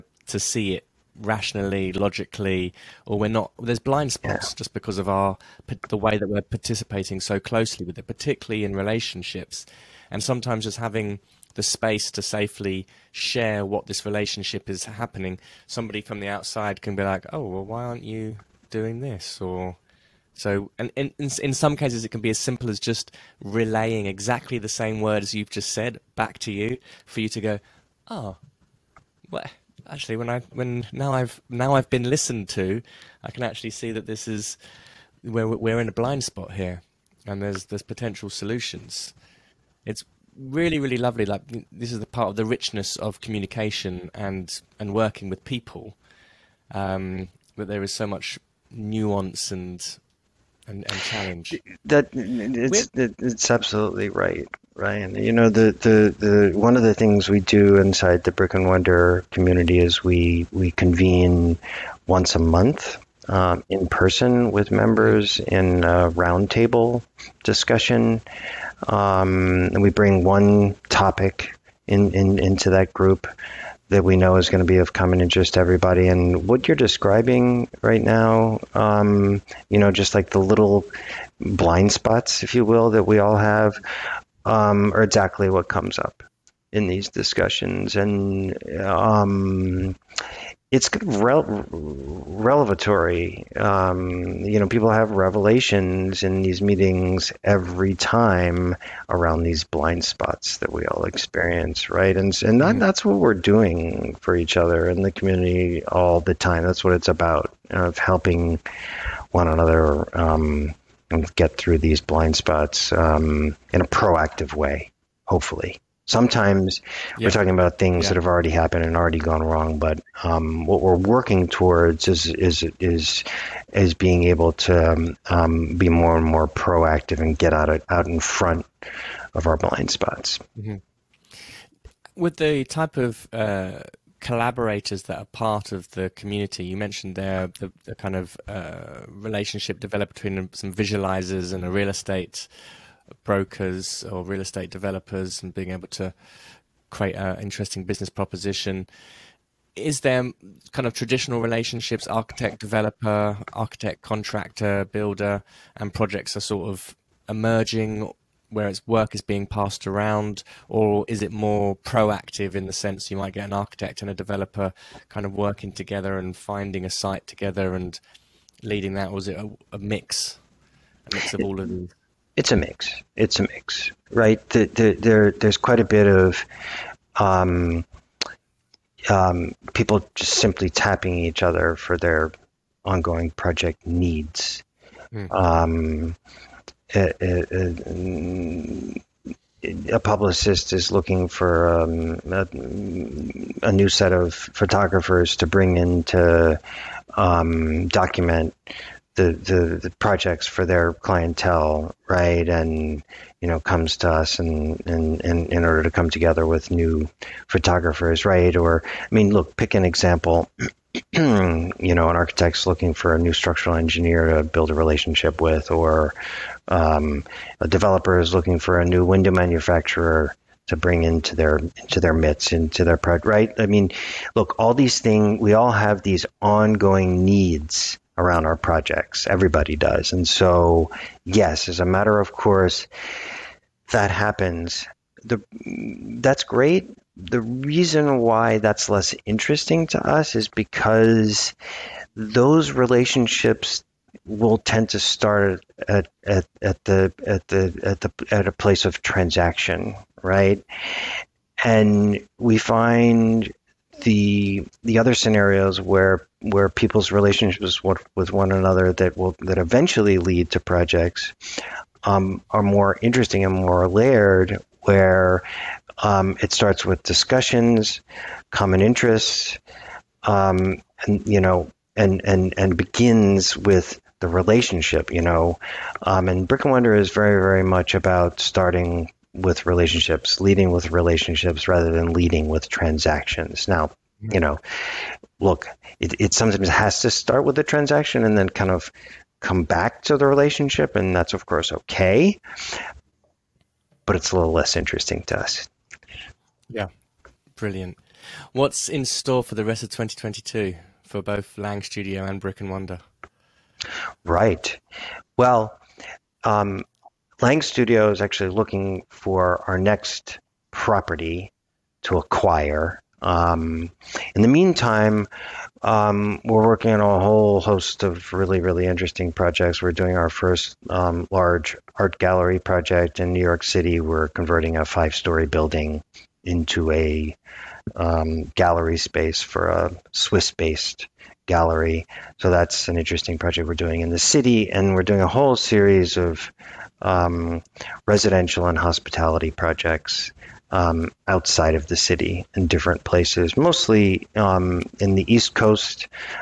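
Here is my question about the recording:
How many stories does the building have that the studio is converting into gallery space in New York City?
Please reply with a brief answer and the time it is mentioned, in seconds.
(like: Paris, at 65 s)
5, at 324 s.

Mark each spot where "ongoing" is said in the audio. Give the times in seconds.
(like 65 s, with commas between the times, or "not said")
182 s, 226 s.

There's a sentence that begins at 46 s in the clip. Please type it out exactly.
Um, that there is so much nuance and and, and challenge.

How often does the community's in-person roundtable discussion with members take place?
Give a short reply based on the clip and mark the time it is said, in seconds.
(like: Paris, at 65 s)
once a month, at 62 s.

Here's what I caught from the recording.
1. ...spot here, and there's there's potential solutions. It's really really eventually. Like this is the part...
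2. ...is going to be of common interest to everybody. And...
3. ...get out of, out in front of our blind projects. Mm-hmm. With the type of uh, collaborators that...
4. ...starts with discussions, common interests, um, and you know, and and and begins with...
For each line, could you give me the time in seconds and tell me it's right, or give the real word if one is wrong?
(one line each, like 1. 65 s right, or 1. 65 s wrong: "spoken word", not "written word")
1. 36 s wrong: "lovely", not "eventually"
2. 74 s right
3. 127 s wrong: "spots", not "projects"
4. 266 s right.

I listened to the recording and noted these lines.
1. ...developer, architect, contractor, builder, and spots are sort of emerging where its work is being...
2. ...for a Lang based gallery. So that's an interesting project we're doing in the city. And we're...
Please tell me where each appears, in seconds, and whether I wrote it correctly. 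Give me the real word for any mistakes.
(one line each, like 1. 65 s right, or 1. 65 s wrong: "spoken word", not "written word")
1. 152 s wrong: "projects", not "spots"
2. 329 s wrong: "Swiss", not "Lang".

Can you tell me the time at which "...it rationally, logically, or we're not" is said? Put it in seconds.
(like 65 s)
0 s.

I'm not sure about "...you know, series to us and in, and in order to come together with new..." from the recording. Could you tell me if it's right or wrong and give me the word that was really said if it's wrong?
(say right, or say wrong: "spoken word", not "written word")
wrong: "comes", not "series".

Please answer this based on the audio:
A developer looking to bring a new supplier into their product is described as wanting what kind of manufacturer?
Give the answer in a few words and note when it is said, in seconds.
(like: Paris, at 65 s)
window manufacturer, at 219 s.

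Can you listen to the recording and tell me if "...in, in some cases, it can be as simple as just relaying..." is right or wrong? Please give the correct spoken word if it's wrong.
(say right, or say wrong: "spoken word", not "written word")
right.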